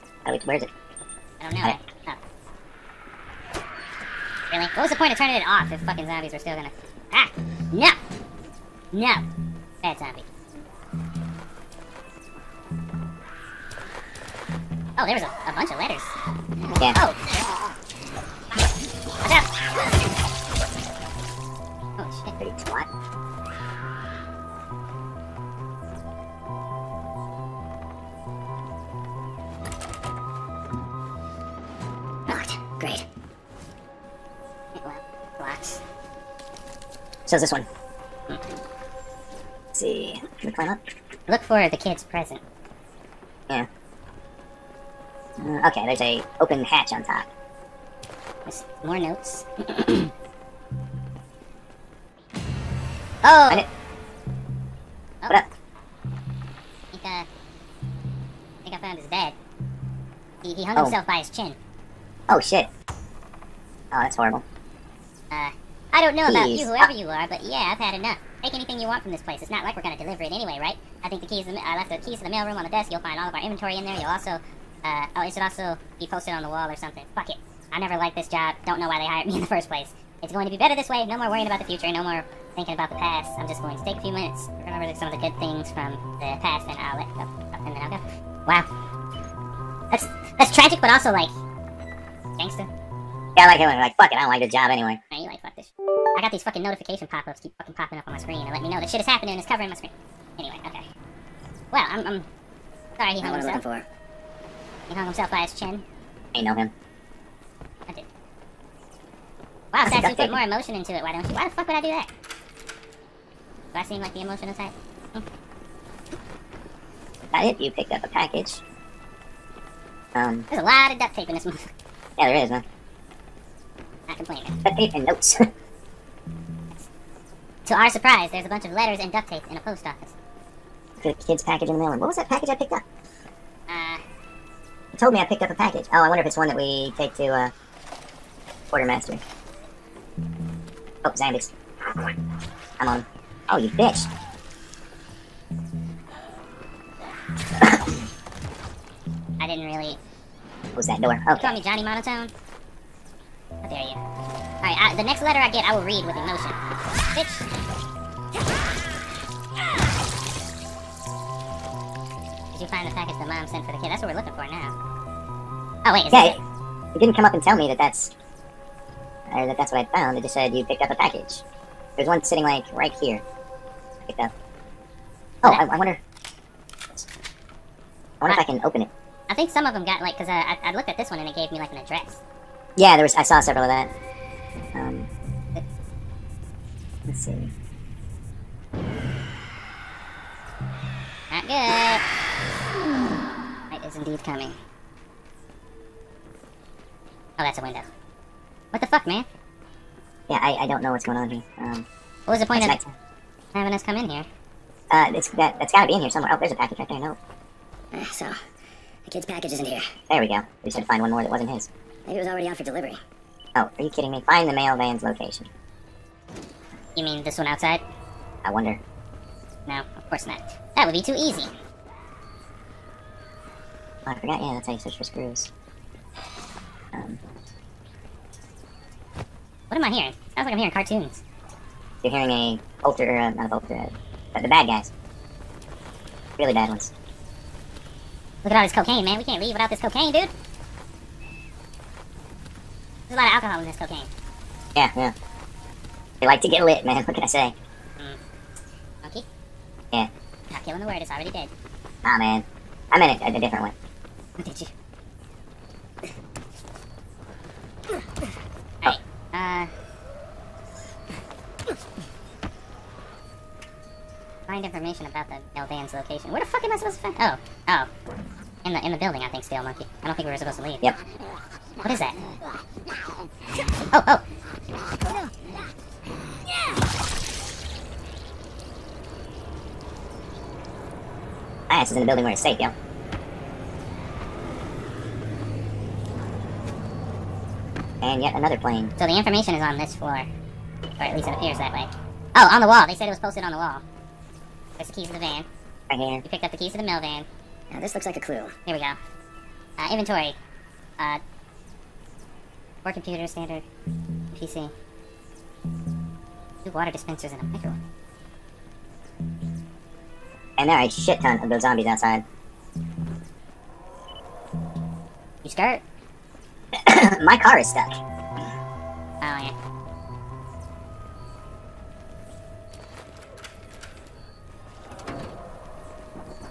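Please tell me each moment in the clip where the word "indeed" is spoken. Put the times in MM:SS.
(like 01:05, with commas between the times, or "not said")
03:13.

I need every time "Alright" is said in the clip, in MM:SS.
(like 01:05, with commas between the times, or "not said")
02:34, 04:18.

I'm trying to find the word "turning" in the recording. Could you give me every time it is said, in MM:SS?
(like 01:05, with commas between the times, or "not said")
00:05.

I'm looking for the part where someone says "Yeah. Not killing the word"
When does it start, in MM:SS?
04:09.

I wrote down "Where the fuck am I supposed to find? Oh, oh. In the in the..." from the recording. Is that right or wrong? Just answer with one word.
right.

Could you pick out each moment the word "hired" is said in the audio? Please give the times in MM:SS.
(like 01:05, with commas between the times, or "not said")
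01:19.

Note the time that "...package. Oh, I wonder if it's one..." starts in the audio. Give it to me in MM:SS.
02:15.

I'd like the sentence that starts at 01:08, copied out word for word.
Take anything you want from this place.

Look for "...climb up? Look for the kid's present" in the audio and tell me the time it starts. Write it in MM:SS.
00:40.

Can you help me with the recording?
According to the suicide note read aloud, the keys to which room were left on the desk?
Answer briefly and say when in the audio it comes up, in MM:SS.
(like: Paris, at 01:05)
The mailroom, at 01:12.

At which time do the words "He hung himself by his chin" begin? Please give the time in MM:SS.
01:44.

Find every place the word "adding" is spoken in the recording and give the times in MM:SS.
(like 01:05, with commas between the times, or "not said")
not said.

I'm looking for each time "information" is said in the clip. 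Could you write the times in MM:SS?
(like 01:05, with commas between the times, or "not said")
04:24, 04:49.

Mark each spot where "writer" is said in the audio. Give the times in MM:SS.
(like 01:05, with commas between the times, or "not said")
not said.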